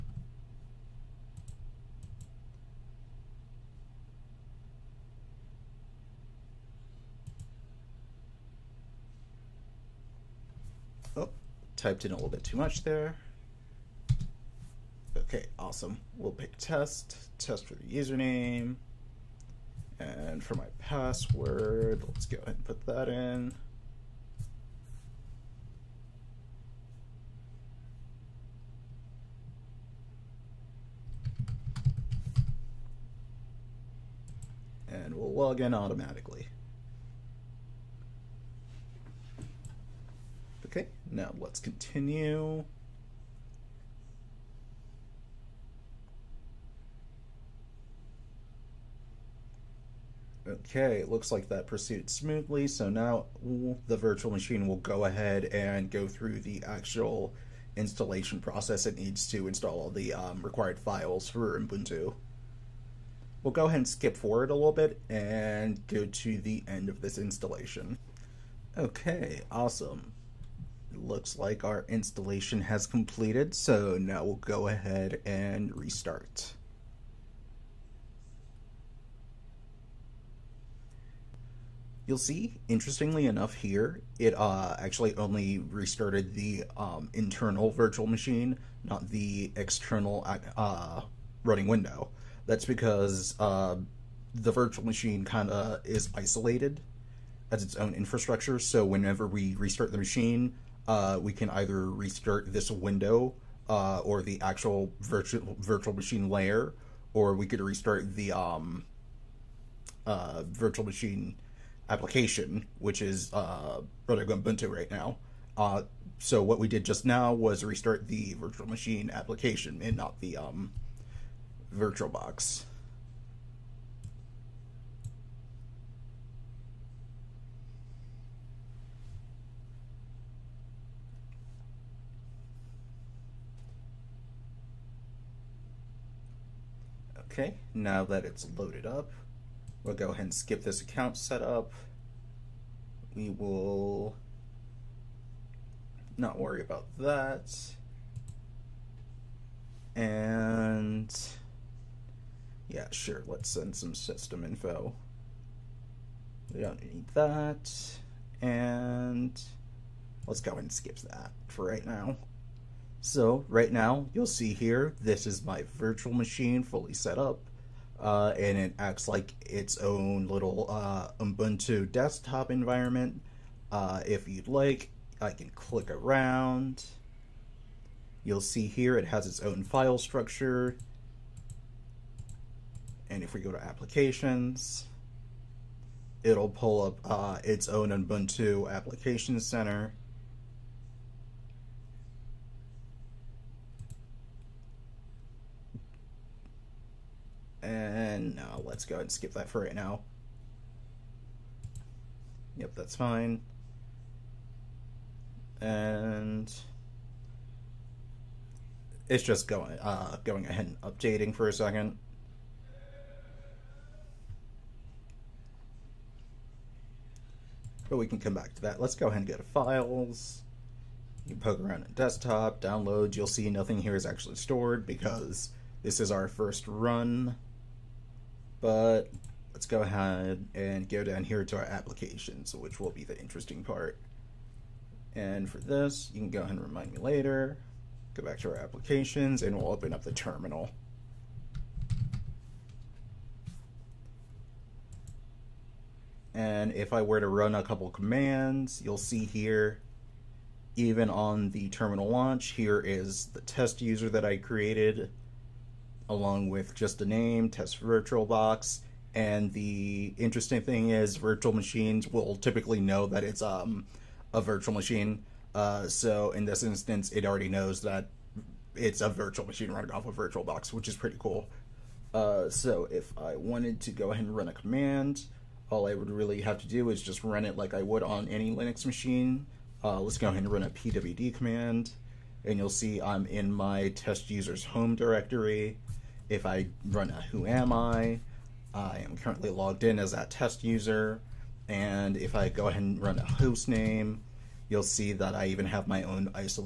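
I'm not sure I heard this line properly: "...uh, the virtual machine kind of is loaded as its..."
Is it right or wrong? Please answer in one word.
wrong.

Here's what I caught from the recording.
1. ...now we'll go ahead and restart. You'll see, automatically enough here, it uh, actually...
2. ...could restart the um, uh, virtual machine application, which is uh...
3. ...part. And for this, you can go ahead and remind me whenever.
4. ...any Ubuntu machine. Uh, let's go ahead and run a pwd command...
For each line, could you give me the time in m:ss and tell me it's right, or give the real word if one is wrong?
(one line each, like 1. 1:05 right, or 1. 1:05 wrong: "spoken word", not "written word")
1. 1:13 wrong: "interestingly", not "automatically"
2. 1:47 right
3. 3:53 wrong: "later", not "whenever"
4. 4:38 wrong: "Linux", not "Ubuntu".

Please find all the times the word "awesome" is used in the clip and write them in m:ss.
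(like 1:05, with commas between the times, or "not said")
0:15, 1:09.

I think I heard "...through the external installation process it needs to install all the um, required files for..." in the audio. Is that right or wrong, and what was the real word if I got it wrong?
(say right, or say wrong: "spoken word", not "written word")
wrong: "actual", not "external".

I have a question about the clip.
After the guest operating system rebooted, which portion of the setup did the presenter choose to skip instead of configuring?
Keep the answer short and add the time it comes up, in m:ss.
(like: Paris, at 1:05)
account setup, at 2:20.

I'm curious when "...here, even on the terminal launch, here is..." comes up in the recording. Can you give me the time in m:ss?
4:09.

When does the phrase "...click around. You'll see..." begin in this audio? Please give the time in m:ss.
2:55.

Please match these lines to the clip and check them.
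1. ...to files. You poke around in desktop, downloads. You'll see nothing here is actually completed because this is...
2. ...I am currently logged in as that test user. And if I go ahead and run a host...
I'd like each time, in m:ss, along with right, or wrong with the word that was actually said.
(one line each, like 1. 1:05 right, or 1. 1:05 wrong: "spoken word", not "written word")
1. 3:39 wrong: "stored", not "completed"
2. 4:48 right.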